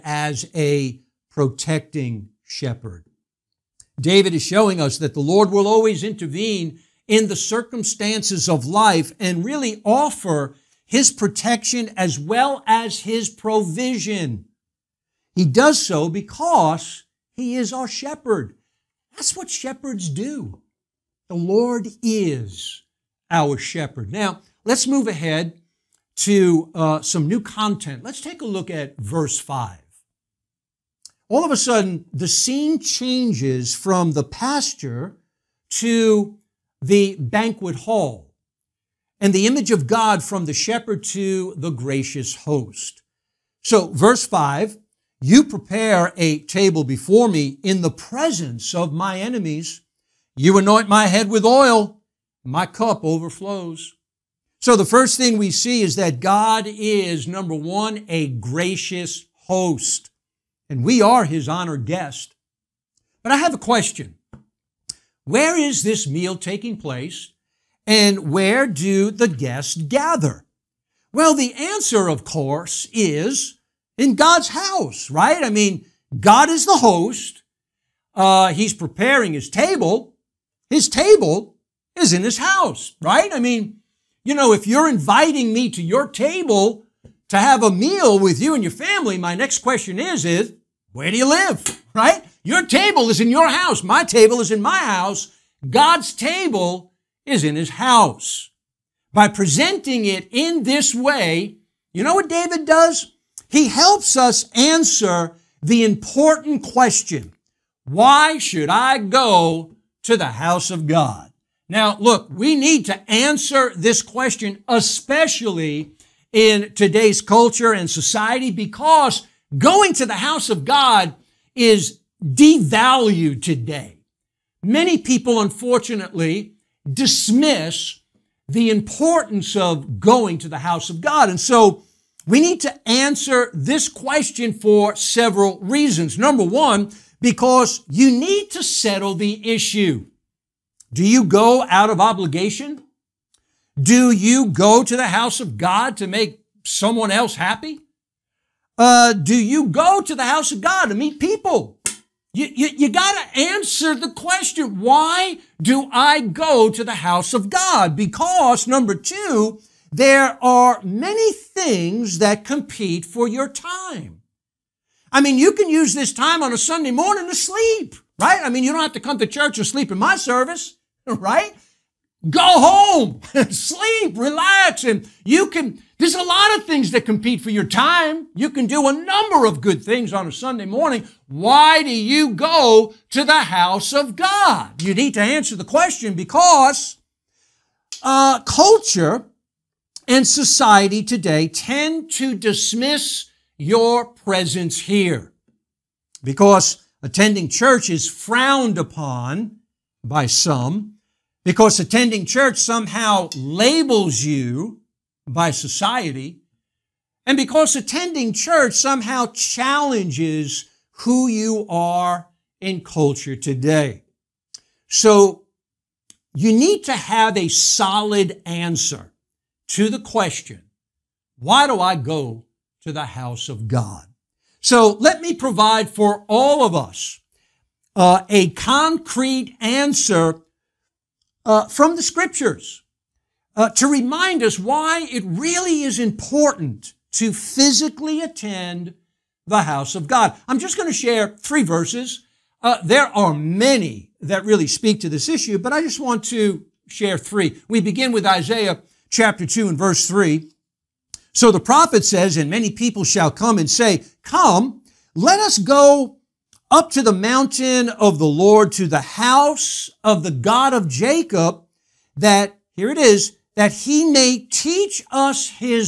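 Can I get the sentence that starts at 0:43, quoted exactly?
So, verse 5 You prepare a table before me in the presence of my enemies.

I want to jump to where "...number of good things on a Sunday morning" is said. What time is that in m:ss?
2:58.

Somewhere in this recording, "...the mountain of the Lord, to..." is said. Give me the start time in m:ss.
4:17.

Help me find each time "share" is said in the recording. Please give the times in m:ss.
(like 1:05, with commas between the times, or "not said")
4:00, 4:06.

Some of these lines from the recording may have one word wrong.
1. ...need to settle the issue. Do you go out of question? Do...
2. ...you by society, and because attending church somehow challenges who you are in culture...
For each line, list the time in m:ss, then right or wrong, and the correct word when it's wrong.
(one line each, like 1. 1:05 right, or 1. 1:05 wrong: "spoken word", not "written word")
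1. 2:18 wrong: "obligation", not "question"
2. 3:24 right.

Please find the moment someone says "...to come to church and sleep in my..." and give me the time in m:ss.
2:48.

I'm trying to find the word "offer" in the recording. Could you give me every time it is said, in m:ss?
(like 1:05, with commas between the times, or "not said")
0:09.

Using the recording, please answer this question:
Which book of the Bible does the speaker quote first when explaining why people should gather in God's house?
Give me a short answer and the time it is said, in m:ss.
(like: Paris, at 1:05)
Isaiah, at 4:08.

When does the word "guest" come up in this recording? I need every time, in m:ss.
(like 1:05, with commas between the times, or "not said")
1:01, 1:09.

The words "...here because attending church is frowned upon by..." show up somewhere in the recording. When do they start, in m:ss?
3:14.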